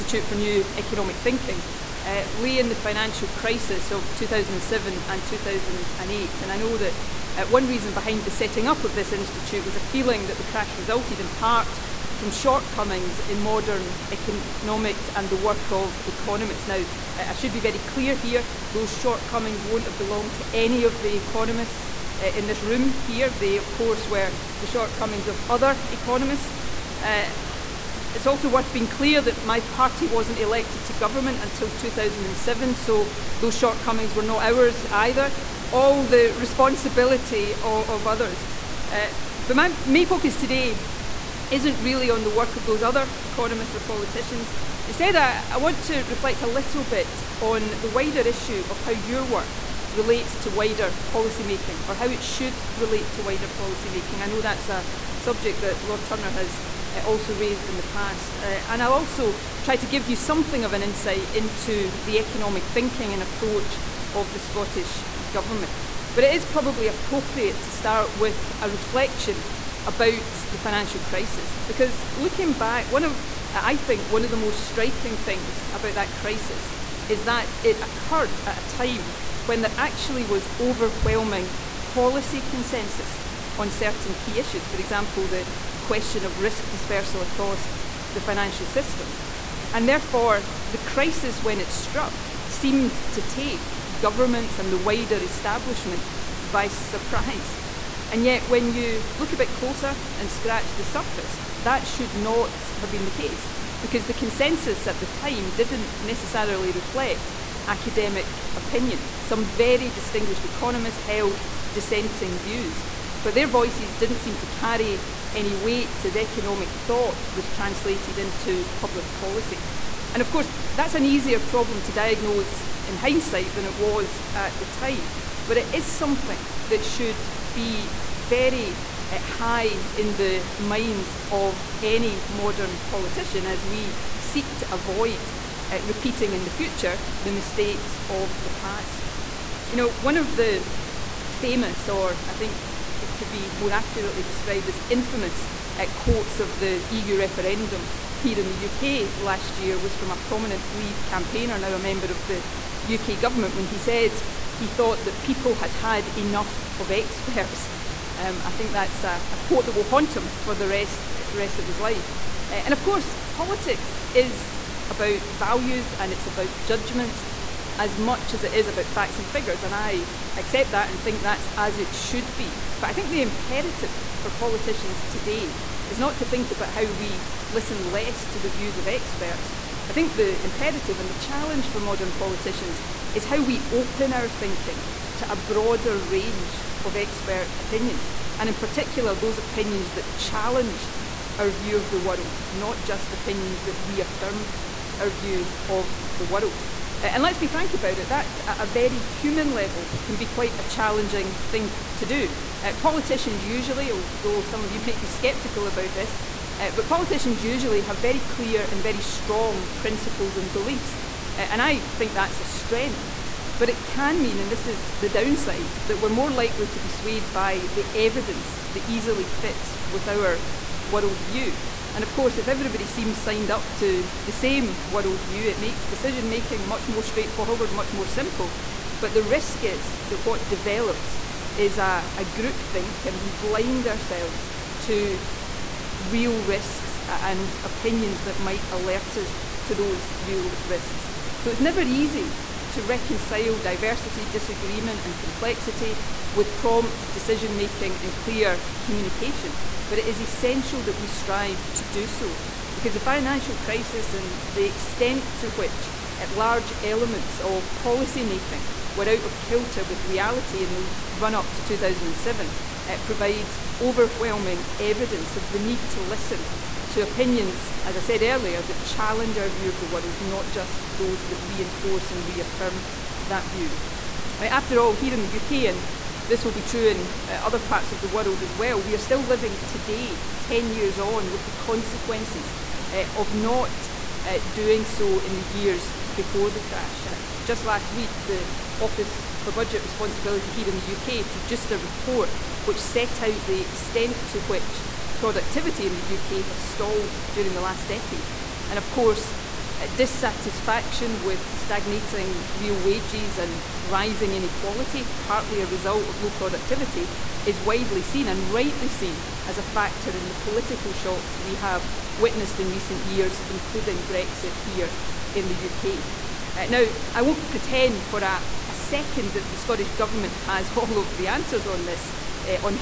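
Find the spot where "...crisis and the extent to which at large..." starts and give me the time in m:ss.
4:13.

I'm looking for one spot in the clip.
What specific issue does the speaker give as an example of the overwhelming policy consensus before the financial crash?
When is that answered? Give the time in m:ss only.
1:26.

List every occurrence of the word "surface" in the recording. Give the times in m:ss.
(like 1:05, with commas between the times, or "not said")
1:40.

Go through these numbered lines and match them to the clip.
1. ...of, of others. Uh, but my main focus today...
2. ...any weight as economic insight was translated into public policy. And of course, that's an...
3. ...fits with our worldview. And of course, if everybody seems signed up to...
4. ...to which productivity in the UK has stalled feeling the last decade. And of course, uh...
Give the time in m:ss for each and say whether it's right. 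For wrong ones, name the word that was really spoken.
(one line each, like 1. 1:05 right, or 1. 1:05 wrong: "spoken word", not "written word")
1. 0:37 right
2. 1:55 wrong: "thought", not "insight"
3. 3:39 right
4. 4:54 wrong: "during", not "feeling".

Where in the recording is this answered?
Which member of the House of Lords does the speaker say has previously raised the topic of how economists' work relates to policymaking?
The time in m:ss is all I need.
0:55.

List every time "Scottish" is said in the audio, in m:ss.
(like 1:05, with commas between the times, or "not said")
1:04, 5:19.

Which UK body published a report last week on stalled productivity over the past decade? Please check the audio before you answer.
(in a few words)
Office for Budget Responsibility.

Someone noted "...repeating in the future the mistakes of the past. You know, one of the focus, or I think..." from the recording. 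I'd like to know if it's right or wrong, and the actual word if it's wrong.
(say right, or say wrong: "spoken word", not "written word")
wrong: "famous", not "focus".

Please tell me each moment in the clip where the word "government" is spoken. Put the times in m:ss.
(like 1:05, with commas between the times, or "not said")
0:30, 1:05, 1:33, 2:33, 5:19.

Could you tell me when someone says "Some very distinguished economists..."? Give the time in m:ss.
1:49.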